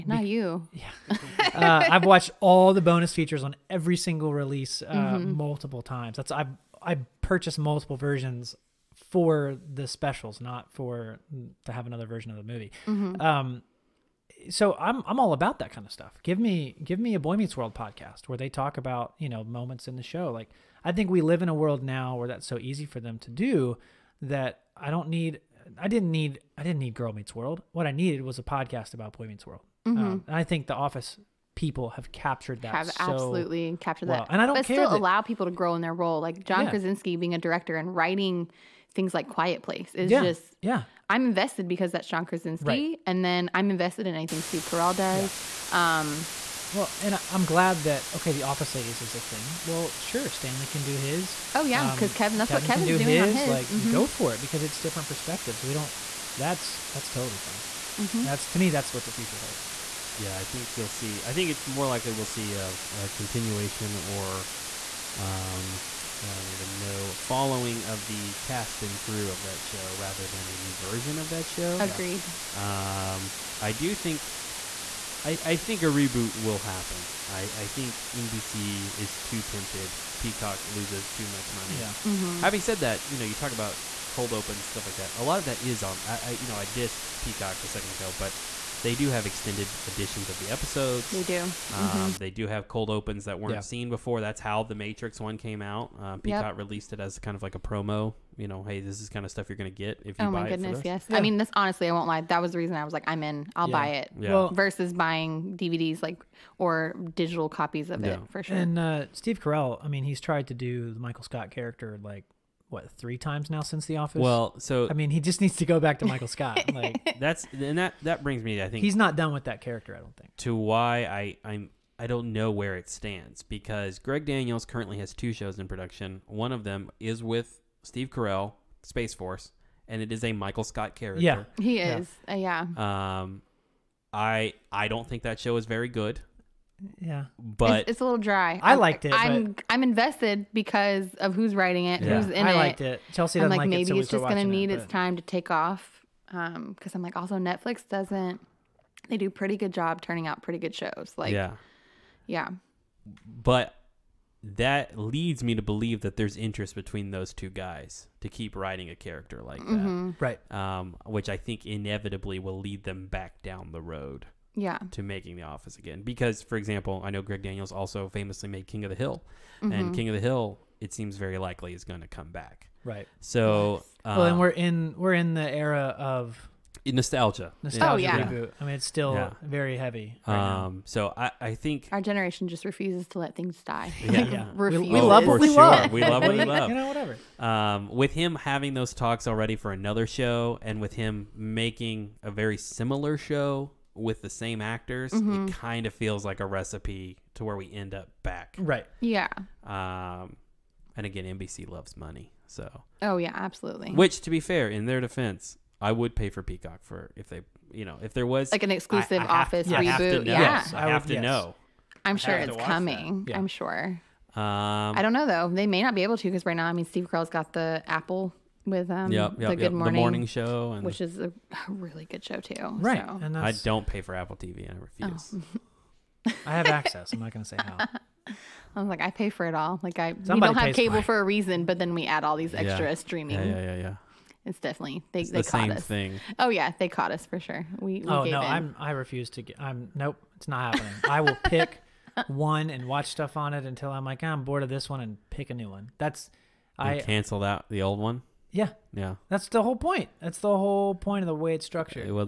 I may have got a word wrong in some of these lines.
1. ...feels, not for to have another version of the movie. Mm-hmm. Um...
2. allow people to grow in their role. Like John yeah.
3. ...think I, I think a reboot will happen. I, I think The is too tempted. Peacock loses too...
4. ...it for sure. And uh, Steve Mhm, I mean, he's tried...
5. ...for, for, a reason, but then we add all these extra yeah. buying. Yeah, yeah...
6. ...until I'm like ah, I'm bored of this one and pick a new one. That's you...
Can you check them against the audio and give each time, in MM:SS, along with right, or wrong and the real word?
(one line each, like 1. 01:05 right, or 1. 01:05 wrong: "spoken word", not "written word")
1. 00:09 wrong: "specials", not "feels"
2. 00:34 right
3. 01:13 wrong: "NBC", not "The"
4. 01:48 wrong: "Carell", not "Mhm"
5. 03:50 wrong: "streaming", not "buying"
6. 04:03 right.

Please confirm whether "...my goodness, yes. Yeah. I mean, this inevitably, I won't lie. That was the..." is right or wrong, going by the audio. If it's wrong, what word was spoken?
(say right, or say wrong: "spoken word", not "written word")
wrong: "honestly", not "inevitably".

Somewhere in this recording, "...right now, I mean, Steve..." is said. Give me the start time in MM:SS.
03:36.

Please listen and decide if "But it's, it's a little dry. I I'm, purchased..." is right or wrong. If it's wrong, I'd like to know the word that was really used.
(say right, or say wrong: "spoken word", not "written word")
wrong: "liked", not "purchased".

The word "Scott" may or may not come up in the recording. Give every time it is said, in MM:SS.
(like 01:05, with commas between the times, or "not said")
01:51, 01:56, 02:10.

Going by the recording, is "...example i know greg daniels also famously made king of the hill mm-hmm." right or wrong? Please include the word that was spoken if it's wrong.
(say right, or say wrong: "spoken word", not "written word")
right.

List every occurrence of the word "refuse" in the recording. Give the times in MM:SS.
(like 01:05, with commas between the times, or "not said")
03:02, 03:44, 03:58.